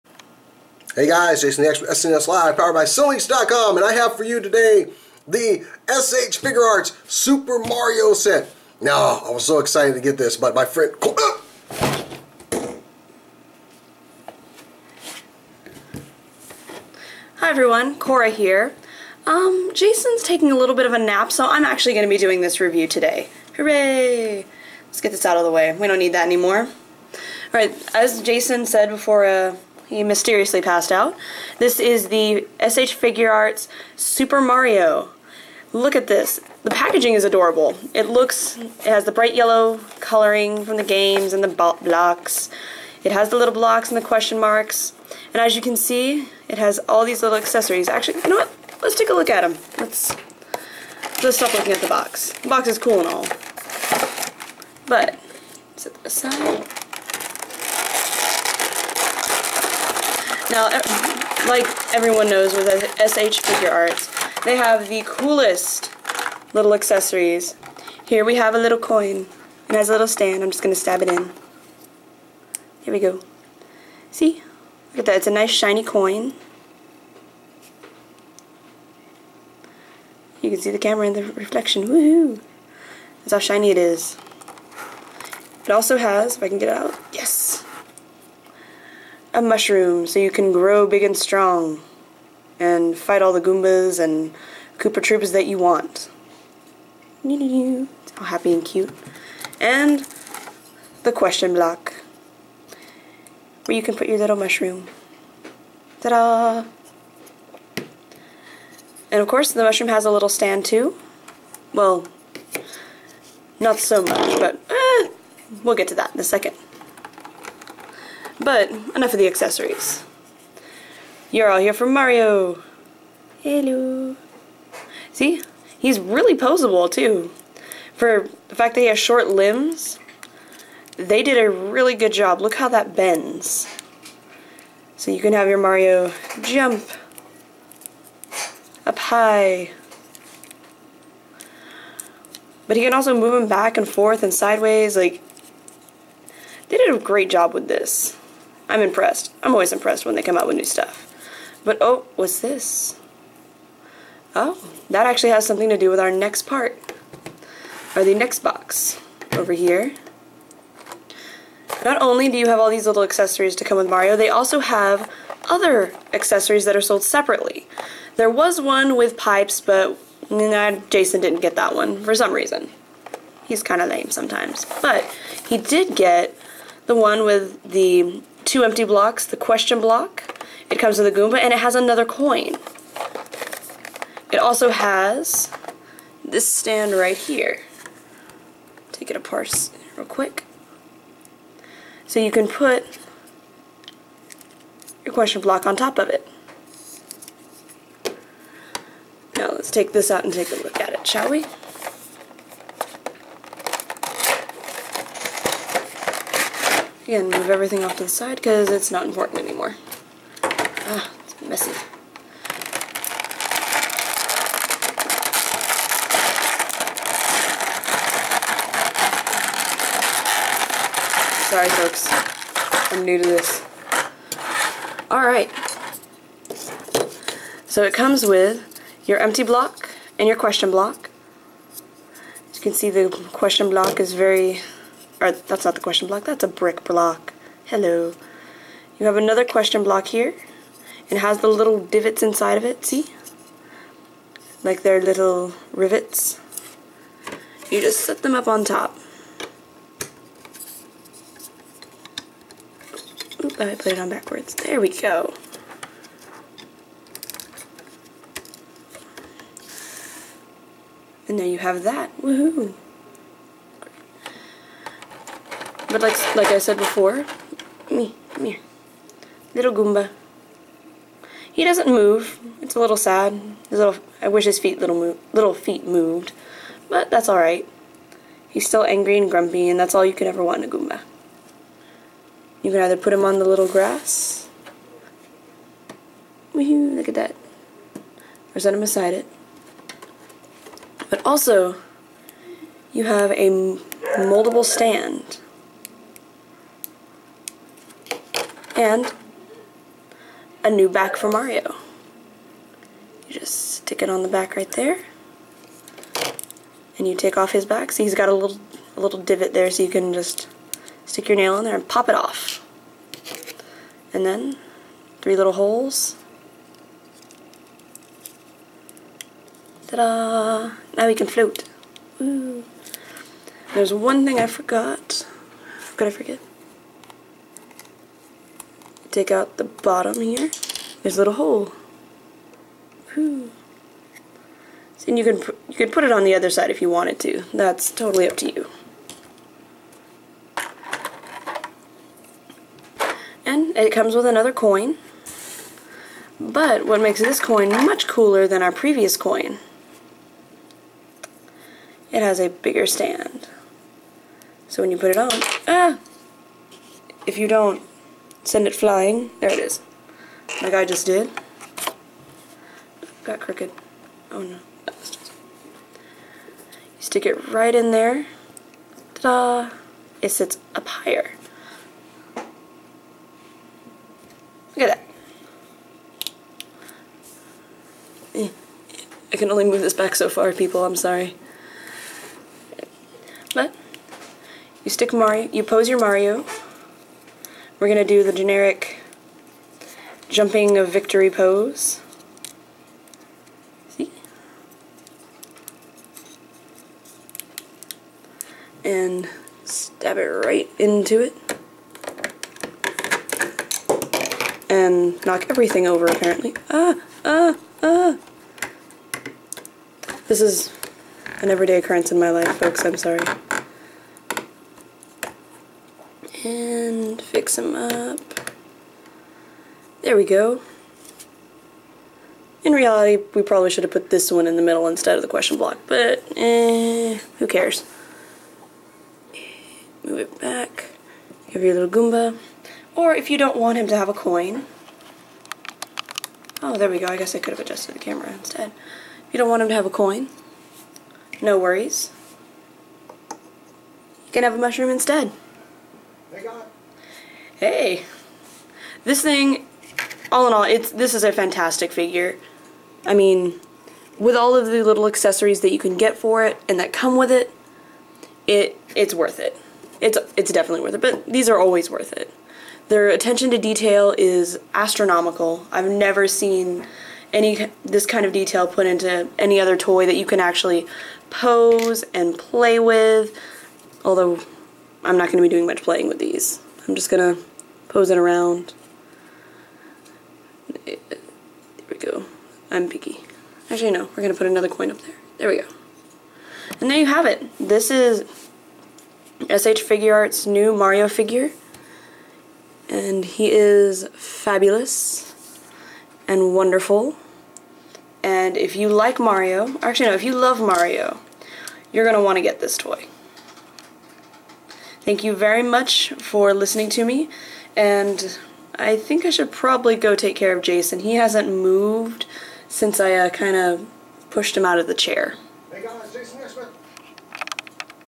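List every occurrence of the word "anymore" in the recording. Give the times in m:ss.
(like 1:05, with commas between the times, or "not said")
0:26, 3:29.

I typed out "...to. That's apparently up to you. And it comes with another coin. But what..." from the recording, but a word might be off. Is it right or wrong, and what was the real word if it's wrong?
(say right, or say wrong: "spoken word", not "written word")
wrong: "totally", not "apparently".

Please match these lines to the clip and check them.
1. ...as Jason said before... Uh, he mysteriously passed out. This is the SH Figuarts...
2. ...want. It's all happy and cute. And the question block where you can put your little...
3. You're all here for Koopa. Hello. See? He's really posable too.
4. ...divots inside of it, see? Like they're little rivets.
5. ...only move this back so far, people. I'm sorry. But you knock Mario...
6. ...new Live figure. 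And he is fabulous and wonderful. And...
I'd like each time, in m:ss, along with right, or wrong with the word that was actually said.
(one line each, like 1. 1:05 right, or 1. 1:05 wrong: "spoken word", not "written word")
1. 0:27 right
2. 1:35 right
3. 2:01 wrong: "Mario", not "Koopa"
4. 4:01 right
5. 6:19 wrong: "stick", not "knock"
6. 8:10 wrong: "Mario", not "Live".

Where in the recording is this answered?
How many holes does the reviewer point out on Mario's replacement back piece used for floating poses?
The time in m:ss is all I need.
5:15.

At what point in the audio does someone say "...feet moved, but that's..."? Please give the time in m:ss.
4:35.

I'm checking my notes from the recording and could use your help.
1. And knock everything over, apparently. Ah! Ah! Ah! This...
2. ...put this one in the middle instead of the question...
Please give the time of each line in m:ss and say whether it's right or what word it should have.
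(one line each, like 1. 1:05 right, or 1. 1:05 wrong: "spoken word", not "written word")
1. 6:44 right
2. 7:03 right.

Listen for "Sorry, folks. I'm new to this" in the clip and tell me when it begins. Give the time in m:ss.
3:41.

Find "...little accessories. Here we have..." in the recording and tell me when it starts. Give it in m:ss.
1:06.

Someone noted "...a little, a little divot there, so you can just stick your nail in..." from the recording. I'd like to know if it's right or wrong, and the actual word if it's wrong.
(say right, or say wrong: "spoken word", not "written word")
right.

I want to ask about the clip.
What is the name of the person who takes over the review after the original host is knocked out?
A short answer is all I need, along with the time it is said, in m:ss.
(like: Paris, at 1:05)
Cora, at 0:17.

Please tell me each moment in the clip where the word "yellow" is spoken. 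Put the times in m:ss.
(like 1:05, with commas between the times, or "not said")
0:39.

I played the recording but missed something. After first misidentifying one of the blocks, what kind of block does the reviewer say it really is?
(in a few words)
brick block.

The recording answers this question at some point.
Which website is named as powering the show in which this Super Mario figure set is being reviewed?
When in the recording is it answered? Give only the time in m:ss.
0:02.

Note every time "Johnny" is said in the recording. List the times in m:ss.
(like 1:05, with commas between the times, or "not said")
not said.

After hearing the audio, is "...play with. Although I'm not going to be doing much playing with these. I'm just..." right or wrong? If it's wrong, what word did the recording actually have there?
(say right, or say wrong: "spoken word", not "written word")
right.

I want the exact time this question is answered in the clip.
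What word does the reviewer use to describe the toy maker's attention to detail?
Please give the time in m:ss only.
7:44.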